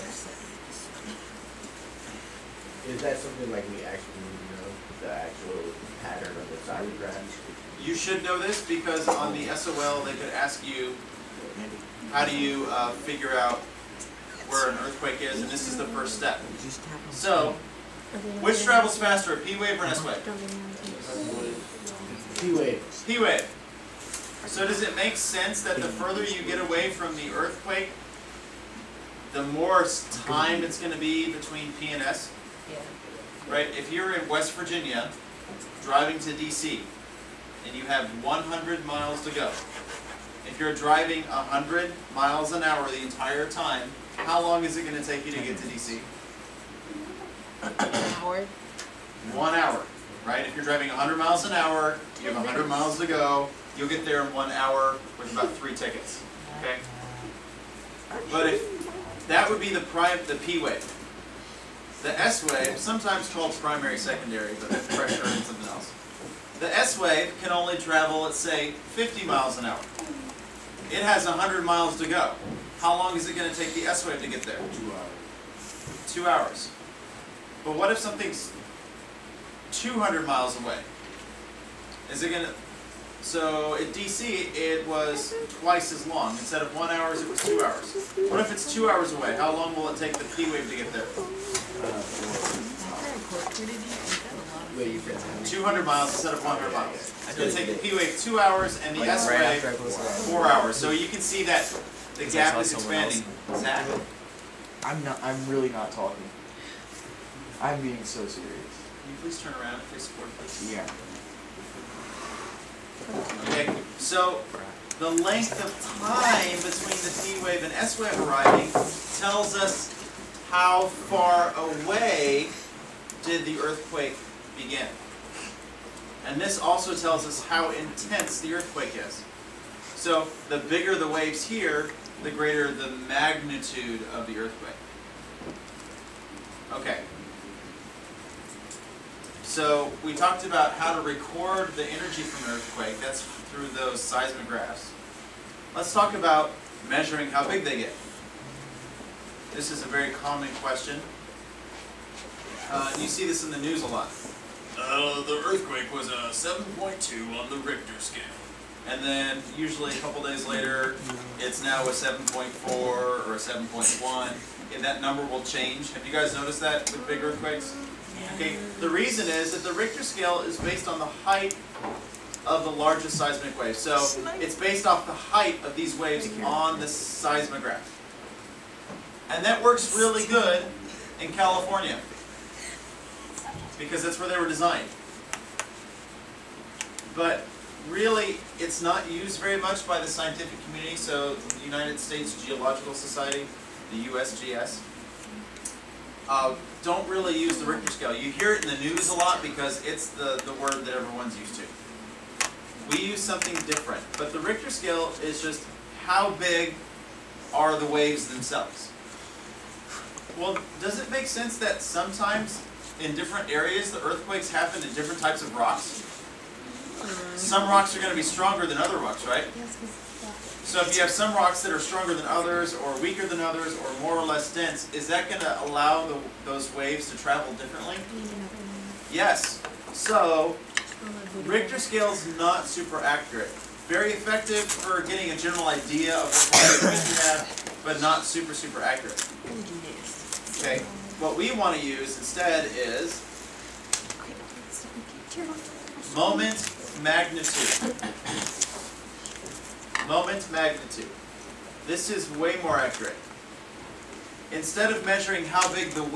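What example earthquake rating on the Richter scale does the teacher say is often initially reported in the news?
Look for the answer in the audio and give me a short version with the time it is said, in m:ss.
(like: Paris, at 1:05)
7.2, at 2:36.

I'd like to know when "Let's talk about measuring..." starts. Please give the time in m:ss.
2:25.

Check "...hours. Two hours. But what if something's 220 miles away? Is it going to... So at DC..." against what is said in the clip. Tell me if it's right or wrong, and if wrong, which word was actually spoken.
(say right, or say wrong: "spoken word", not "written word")
wrong: "200", not "220".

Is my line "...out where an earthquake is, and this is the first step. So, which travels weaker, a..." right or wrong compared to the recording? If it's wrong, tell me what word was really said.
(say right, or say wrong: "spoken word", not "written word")
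wrong: "faster", not "weaker".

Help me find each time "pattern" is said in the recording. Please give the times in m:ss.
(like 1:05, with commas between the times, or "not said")
0:06.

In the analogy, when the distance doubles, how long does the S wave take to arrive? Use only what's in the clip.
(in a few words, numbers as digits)
4 hours.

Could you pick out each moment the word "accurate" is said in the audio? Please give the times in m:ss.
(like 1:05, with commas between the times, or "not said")
3:52, 3:58, 4:12.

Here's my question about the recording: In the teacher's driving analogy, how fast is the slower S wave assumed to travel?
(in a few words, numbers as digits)
50 miles an hour.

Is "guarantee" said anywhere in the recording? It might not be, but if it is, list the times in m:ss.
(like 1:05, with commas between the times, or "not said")
not said.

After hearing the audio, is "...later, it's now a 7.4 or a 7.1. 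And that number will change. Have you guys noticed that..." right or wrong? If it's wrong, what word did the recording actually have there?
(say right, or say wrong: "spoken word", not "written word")
right.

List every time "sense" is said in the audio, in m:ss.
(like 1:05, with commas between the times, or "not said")
0:25, 3:31.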